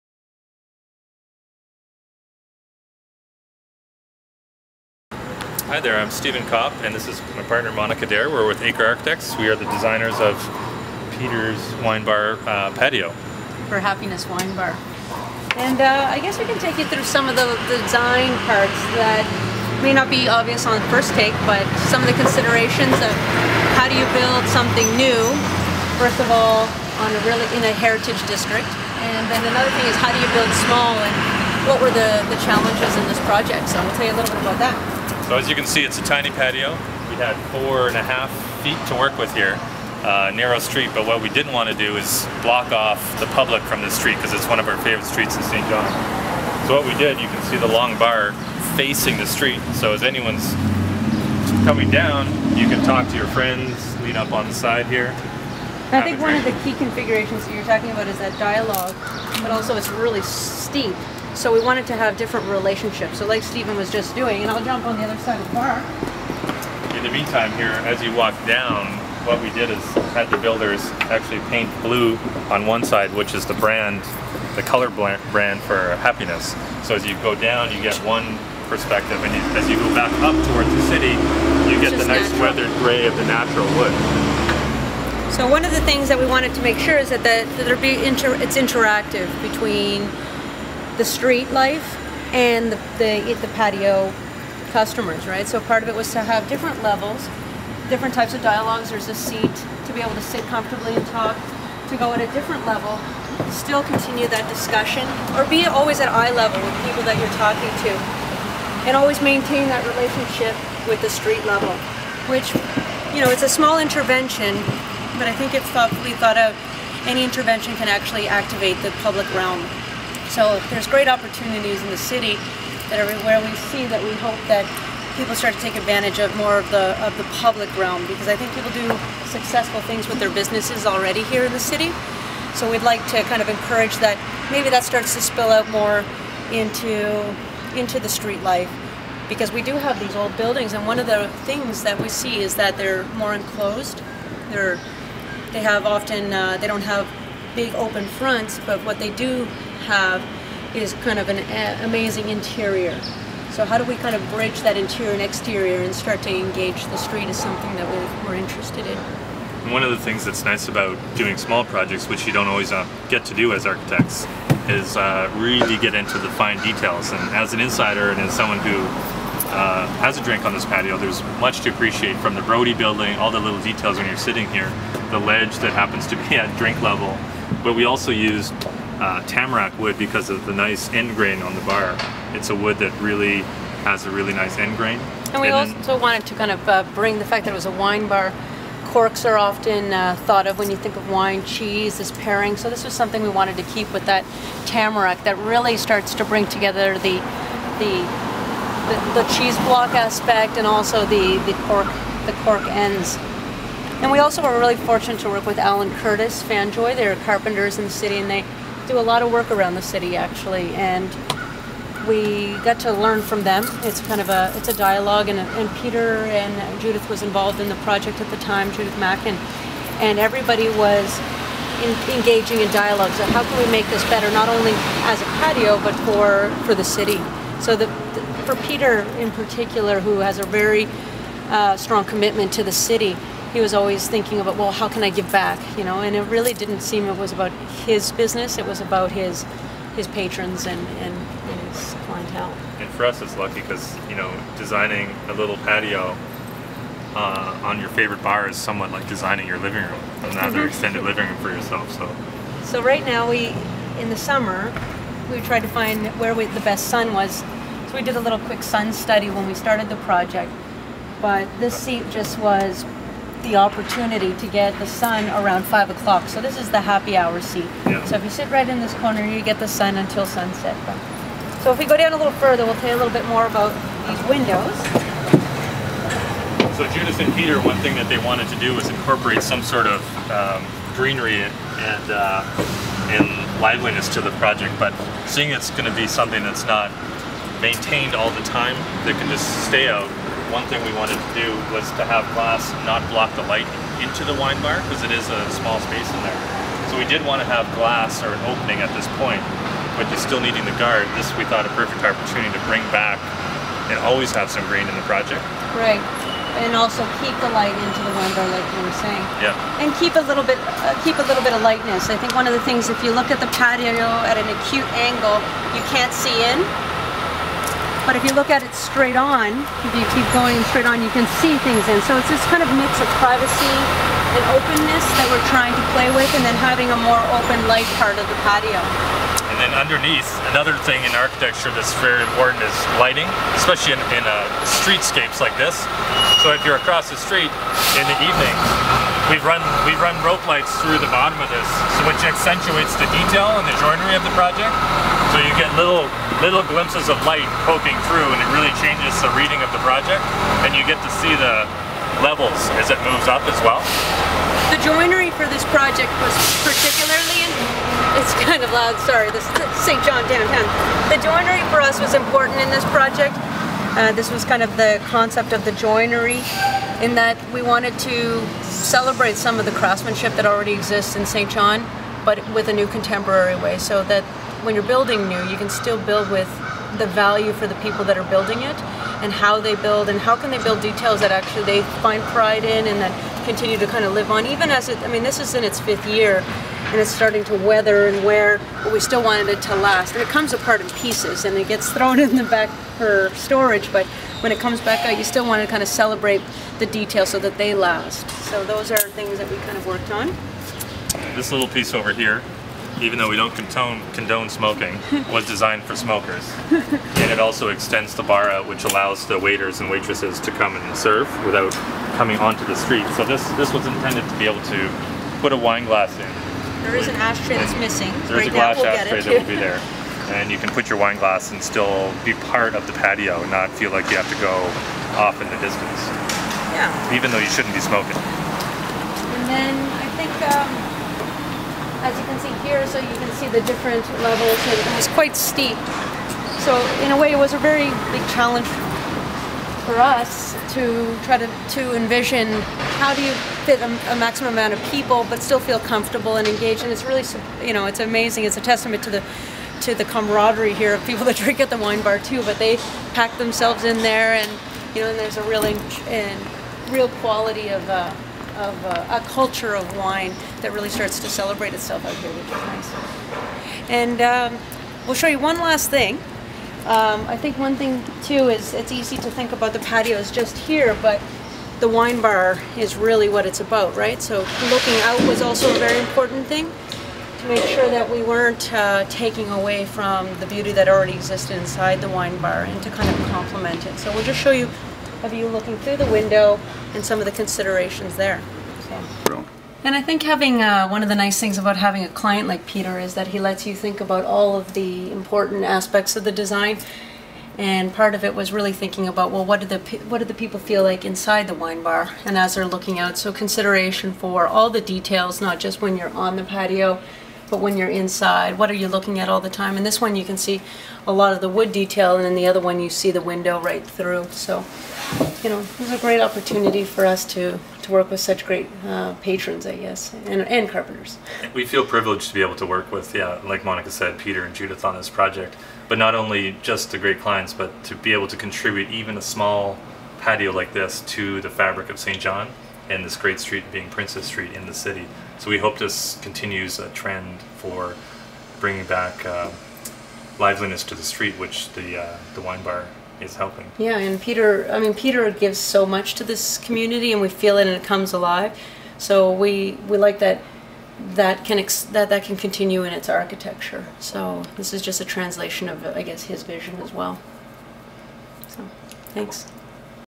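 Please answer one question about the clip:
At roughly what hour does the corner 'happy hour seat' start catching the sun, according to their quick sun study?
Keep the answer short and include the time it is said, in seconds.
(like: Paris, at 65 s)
5 o'clock, at 265 s.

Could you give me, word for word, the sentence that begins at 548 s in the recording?
So we we like that that can that that can continue in its architecture.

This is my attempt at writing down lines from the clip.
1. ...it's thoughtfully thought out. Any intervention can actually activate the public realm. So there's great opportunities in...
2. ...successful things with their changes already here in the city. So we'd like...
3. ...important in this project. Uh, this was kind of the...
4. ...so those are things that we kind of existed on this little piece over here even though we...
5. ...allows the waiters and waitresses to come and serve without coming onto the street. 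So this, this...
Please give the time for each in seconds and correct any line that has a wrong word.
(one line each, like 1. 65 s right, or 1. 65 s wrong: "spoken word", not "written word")
1. 115 s right
2. 129 s wrong: "businesses", not "changes"
3. 362 s right
4. 398 s wrong: "worked", not "existed"
5. 408 s right.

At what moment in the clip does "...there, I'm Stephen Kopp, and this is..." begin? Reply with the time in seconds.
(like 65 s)
5 s.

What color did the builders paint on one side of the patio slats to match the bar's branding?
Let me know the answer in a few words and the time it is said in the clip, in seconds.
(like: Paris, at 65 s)
Blue, at 71 s.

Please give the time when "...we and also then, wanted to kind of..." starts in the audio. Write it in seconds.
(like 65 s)
185 s.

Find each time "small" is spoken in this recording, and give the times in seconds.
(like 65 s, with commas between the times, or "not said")
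30 s, 113 s, 161 s, 295 s, 529 s.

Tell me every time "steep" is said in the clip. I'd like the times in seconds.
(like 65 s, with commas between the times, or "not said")
60 s, 435 s.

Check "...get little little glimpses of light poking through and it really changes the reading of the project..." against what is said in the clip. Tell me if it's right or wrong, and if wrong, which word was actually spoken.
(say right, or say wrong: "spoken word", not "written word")
right.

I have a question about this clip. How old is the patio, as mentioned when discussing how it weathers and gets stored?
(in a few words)
Fifth year.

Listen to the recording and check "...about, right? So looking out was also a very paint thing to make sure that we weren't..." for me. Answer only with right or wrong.
wrong.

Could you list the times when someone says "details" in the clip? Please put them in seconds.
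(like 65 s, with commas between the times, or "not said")
166 s, 173 s, 343 s, 380 s, 396 s, 504 s, 511 s.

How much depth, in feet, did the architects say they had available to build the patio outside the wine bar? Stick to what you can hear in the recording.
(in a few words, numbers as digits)
4.5 feet.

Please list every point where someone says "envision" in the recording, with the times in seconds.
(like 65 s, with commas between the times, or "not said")
441 s.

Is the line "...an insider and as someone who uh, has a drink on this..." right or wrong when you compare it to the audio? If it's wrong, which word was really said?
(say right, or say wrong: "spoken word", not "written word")
right.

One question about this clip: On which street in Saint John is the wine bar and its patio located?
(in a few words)
Princess Street.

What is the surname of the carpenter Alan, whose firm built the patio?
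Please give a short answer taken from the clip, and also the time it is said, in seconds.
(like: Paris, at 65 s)
Curtis, at 205 s.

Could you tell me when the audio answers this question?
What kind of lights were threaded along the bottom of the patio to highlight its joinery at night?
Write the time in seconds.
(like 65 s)
340 s.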